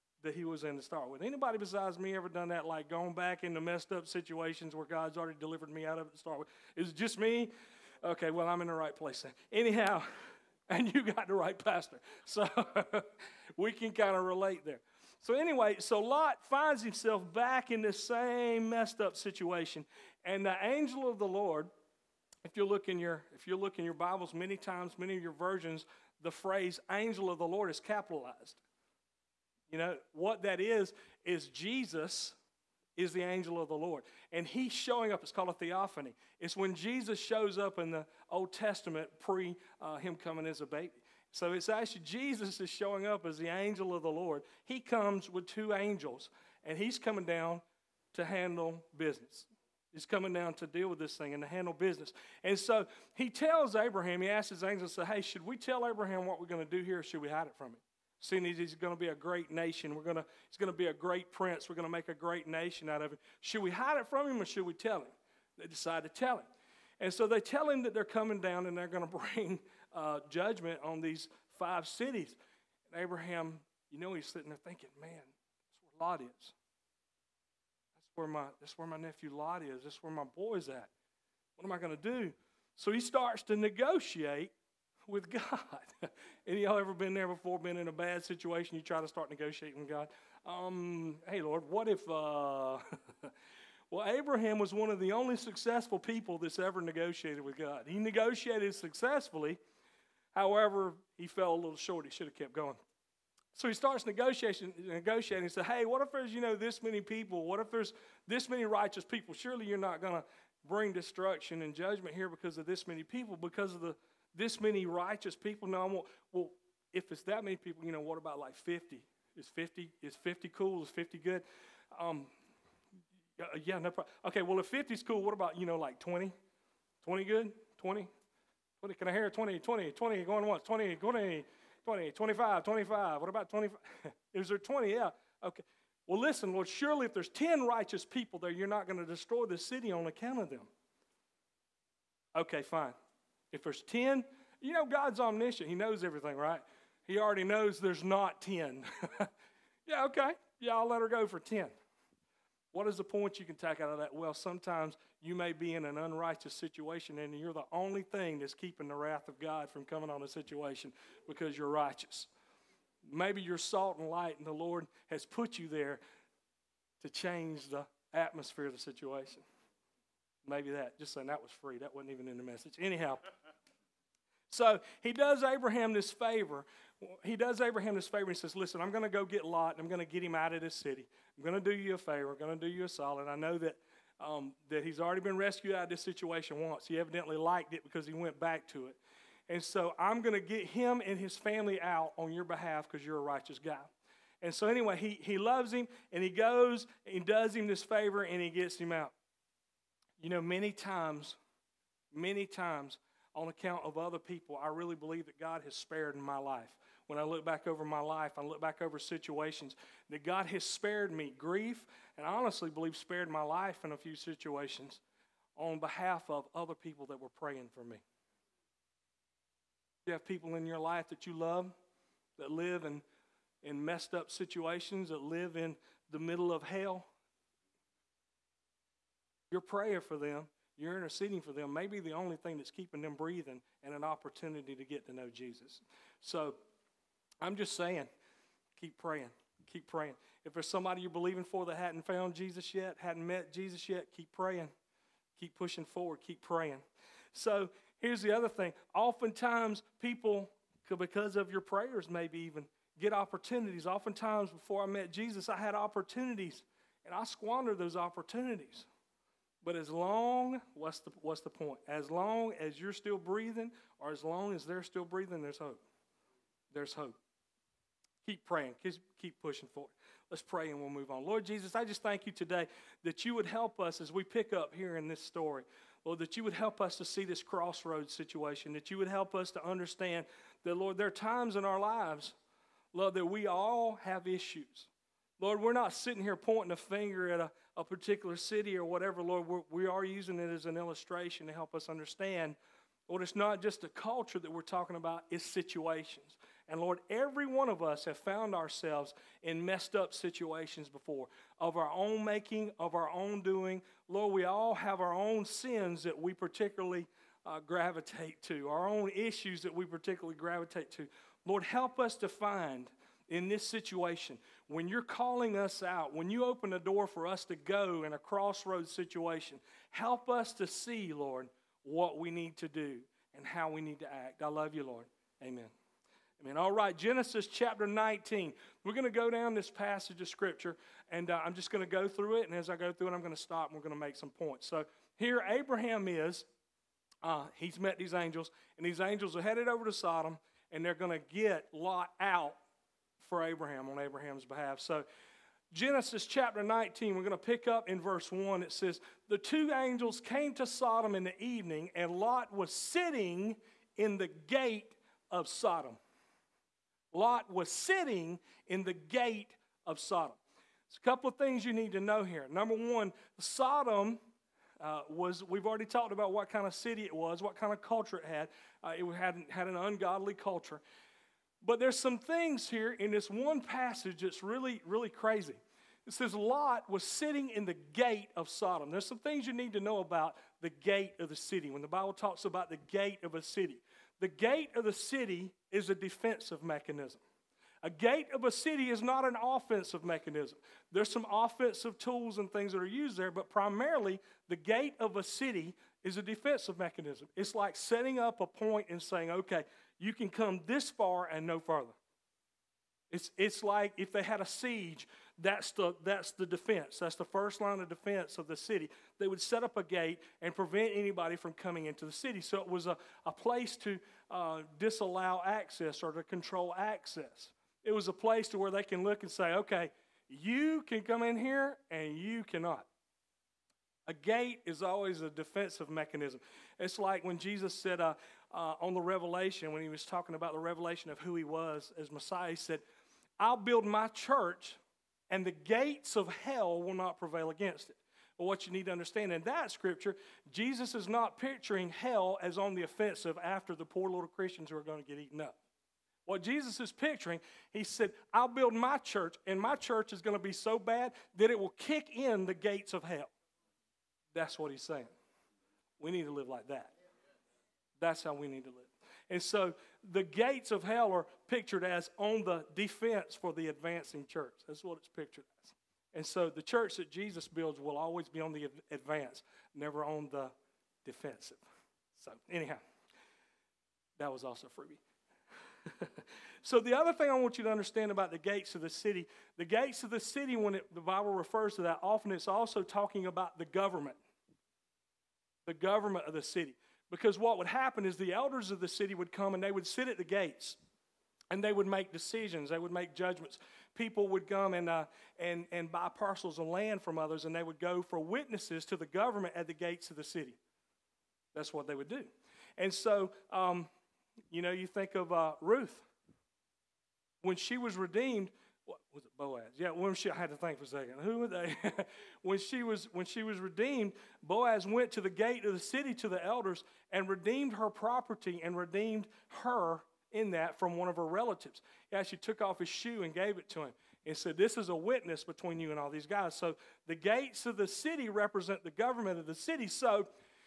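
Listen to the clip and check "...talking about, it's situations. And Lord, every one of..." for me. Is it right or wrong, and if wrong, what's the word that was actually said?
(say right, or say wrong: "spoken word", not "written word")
right.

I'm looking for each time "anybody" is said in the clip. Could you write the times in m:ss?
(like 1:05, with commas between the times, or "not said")
0:01, 6:50.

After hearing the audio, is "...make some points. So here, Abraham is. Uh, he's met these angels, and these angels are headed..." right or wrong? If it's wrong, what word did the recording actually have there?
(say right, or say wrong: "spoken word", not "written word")
right.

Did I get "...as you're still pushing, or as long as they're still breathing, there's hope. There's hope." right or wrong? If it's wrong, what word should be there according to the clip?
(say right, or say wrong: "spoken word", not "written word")
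wrong: "breathing", not "pushing".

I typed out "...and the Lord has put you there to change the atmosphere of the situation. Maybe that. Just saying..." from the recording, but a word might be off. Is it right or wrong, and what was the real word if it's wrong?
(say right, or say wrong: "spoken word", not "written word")
right.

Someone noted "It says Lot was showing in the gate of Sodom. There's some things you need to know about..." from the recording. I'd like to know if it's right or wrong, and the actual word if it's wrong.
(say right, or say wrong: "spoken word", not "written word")
wrong: "sitting", not "showing".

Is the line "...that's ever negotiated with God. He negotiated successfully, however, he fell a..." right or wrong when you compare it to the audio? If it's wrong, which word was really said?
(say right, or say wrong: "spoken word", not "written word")
right.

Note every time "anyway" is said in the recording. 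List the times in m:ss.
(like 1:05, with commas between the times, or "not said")
0:15, 3:14.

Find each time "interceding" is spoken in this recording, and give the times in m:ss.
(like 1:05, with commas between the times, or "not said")
3:50.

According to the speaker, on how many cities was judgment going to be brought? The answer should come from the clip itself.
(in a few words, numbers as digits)
5.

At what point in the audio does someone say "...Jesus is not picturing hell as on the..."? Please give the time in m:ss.
7:20.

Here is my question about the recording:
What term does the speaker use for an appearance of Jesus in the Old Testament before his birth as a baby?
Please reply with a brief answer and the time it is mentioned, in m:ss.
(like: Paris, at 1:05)
Theophany, at 0:35.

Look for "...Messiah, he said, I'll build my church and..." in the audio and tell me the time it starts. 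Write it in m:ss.
7:12.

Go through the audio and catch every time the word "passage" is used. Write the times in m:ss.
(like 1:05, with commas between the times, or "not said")
5:29, 6:13.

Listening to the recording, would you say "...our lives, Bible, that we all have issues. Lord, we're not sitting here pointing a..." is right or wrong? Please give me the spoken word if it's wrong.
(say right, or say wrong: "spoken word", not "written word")
wrong: "Lord", not "Bible".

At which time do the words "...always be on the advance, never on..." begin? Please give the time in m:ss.
7:47.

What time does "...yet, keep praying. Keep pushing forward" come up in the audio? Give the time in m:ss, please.
4:03.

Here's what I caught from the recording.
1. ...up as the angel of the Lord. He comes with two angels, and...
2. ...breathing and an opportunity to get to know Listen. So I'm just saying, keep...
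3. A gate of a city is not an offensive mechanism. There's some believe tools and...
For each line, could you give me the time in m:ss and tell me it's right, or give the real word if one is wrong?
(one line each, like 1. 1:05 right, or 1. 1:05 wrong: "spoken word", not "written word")
1. 0:43 right
2. 3:53 wrong: "Jesus", not "Listen"
3. 6:27 wrong: "offensive", not "believe".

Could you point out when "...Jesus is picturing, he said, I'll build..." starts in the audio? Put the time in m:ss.
7:26.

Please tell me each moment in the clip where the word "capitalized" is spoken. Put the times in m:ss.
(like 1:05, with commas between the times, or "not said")
0:27.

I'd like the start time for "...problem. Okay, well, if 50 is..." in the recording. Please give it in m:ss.
2:03.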